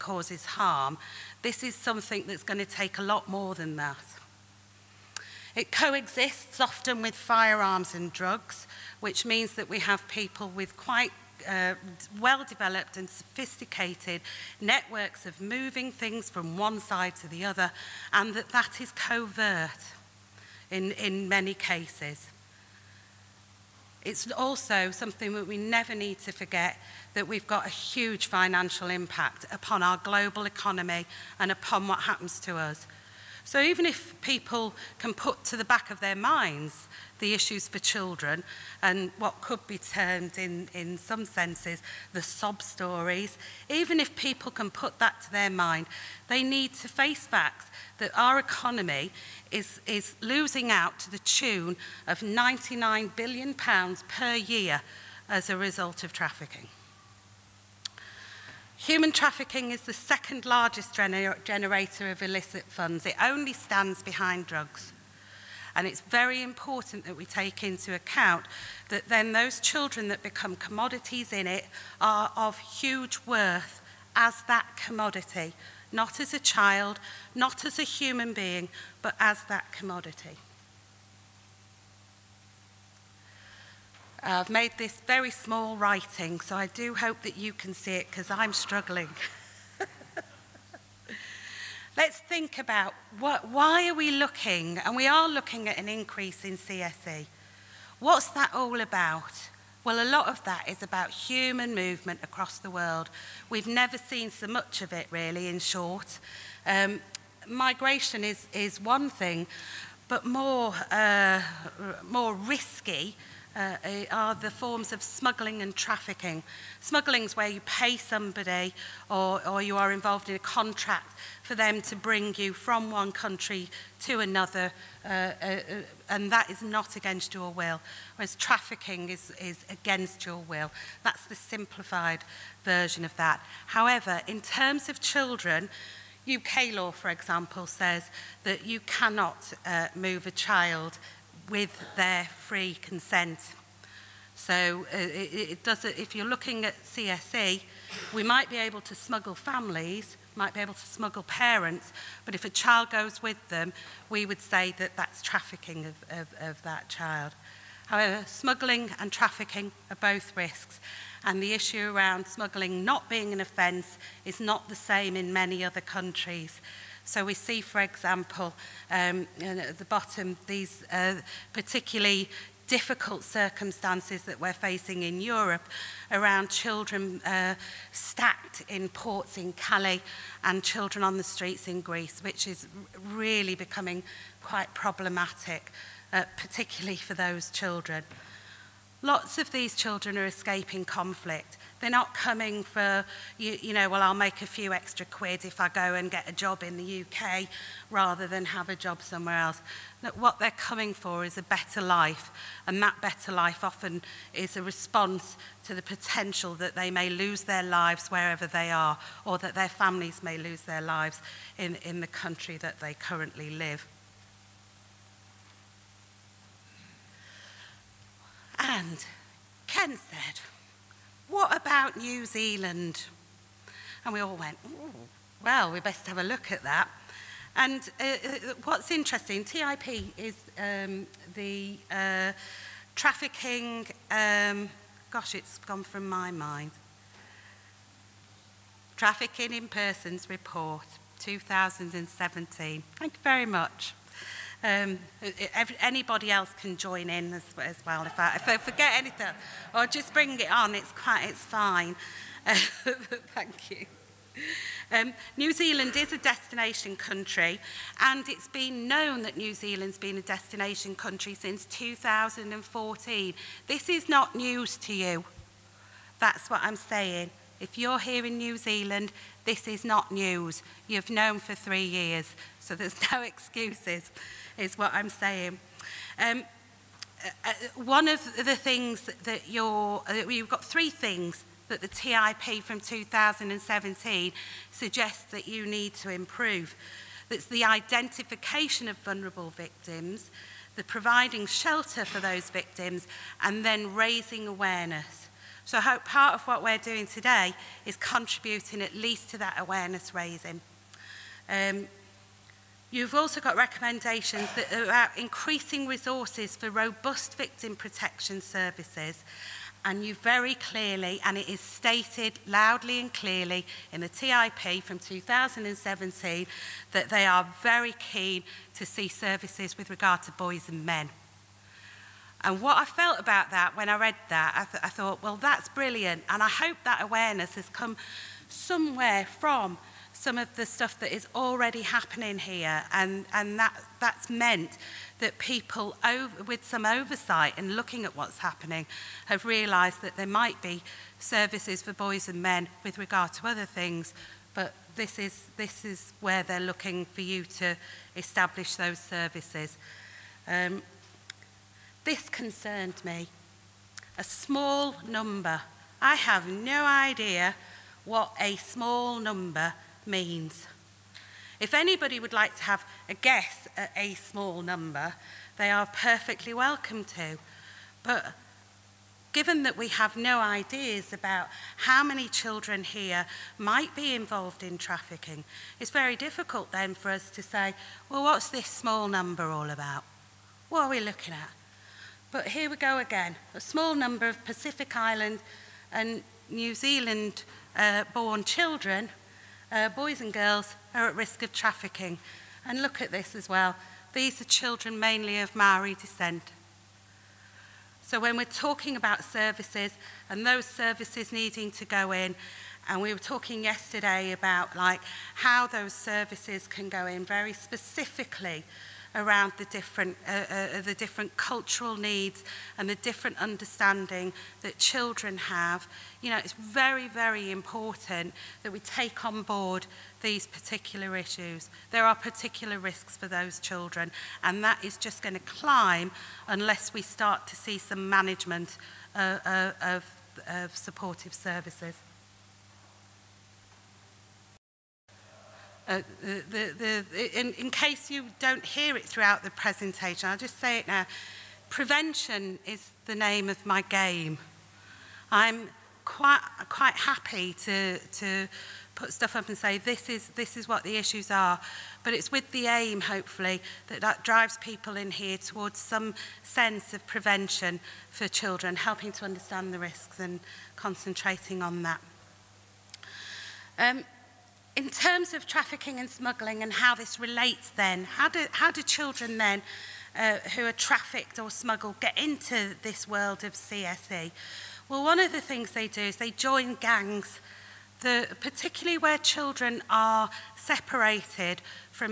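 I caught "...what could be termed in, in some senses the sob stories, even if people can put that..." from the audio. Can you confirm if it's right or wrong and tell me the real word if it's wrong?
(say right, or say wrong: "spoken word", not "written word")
right.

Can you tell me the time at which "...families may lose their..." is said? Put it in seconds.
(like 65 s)
209 s.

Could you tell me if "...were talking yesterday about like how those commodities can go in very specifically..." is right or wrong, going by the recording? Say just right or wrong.
wrong.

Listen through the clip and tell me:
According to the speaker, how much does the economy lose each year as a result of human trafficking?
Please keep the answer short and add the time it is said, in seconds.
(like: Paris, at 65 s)
£99 billion, at 52 s.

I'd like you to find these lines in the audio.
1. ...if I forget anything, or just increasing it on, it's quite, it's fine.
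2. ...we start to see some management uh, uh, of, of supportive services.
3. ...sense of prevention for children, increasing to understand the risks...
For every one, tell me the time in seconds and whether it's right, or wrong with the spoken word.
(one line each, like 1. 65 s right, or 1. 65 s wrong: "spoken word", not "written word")
1. 248 s wrong: "bring", not "increasing"
2. 426 s right
3. 456 s wrong: "helping", not "increasing".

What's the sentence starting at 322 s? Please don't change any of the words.
And what I felt about that when I read that, I, th I thought, well, that's brilliant.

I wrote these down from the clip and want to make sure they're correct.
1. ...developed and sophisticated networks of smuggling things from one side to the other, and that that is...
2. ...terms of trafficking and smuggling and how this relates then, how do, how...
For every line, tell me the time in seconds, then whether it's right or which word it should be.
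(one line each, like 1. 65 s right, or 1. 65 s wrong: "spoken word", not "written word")
1. 12 s wrong: "moving", not "smuggling"
2. 464 s right.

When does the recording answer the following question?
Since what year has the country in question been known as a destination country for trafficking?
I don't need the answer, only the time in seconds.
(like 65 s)
261 s.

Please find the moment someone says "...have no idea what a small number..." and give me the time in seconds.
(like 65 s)
356 s.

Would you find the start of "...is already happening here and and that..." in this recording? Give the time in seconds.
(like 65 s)
331 s.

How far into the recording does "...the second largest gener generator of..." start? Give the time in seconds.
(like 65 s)
59 s.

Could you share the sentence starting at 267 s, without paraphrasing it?
If you're here in New Zealand, this is not news.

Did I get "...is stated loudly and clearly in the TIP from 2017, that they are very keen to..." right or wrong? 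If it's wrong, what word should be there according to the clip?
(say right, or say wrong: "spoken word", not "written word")
right.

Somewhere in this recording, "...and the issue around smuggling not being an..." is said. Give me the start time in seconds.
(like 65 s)
161 s.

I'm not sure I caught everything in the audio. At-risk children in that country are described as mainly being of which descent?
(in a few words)
Maori.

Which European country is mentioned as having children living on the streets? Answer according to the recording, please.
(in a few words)
Greece.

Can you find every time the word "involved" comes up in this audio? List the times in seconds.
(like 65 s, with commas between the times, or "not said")
119 s, 374 s.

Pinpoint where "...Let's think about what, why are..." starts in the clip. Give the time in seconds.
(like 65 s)
91 s.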